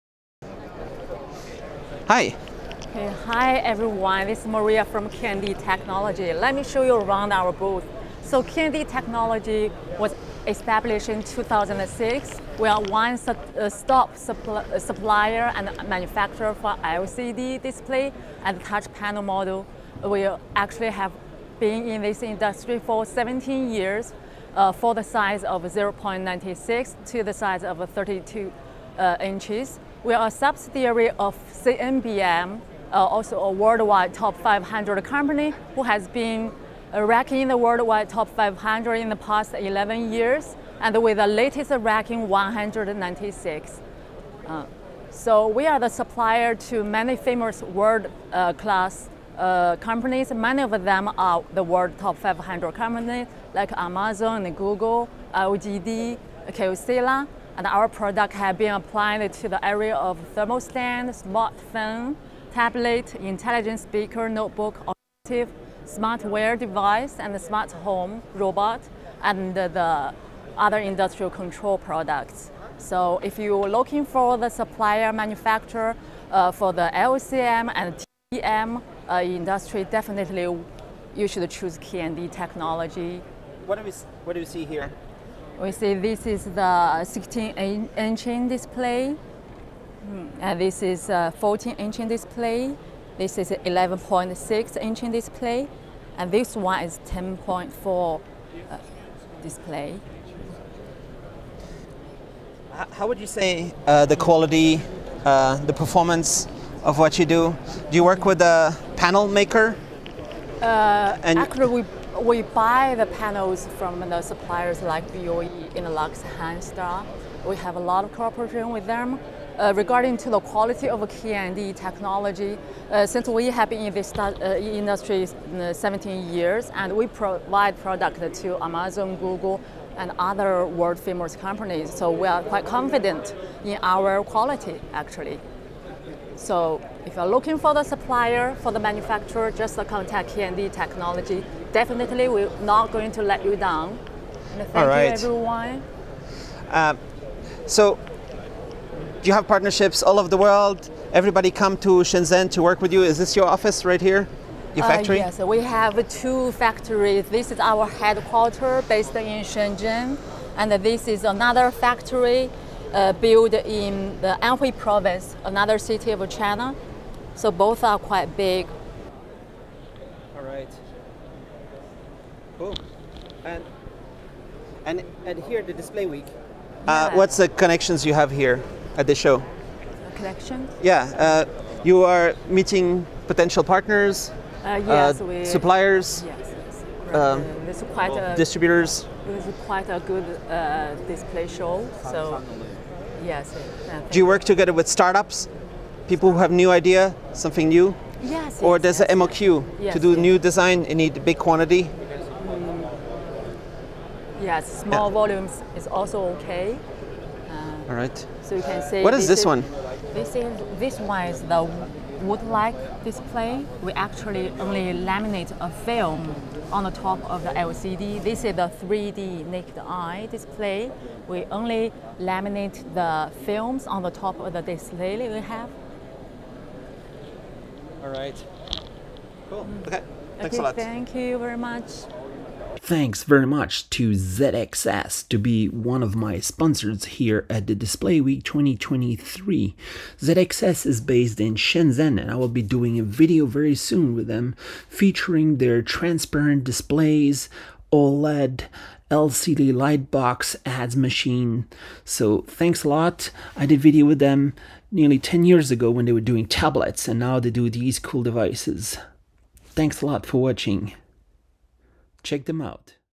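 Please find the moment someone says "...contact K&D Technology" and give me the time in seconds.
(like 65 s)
139 s.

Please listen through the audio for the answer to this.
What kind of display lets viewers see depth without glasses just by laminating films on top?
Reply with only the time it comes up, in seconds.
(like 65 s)
218 s.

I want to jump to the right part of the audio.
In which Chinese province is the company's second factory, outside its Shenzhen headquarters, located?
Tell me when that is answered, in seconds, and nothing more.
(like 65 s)
164 s.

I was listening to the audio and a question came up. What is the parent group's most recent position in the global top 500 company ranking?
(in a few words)
196.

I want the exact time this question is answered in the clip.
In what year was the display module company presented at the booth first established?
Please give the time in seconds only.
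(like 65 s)
11 s.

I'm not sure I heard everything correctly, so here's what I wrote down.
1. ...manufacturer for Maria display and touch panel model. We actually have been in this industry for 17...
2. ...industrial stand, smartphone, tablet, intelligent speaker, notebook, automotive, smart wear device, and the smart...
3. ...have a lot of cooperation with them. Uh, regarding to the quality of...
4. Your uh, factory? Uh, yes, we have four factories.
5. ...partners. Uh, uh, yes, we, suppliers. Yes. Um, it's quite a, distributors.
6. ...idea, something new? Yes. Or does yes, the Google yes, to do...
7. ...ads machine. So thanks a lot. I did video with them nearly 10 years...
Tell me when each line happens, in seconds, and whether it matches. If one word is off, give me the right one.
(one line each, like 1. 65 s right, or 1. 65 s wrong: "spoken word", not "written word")
1. 15 s wrong: "LCD", not "Maria"
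2. 60 s wrong: "thermal", not "industrial"
3. 117 s right
4. 154 s wrong: "two", not "four"
5. 183 s right
6. 196 s wrong: "MOQ", not "Google"
7. 250 s right.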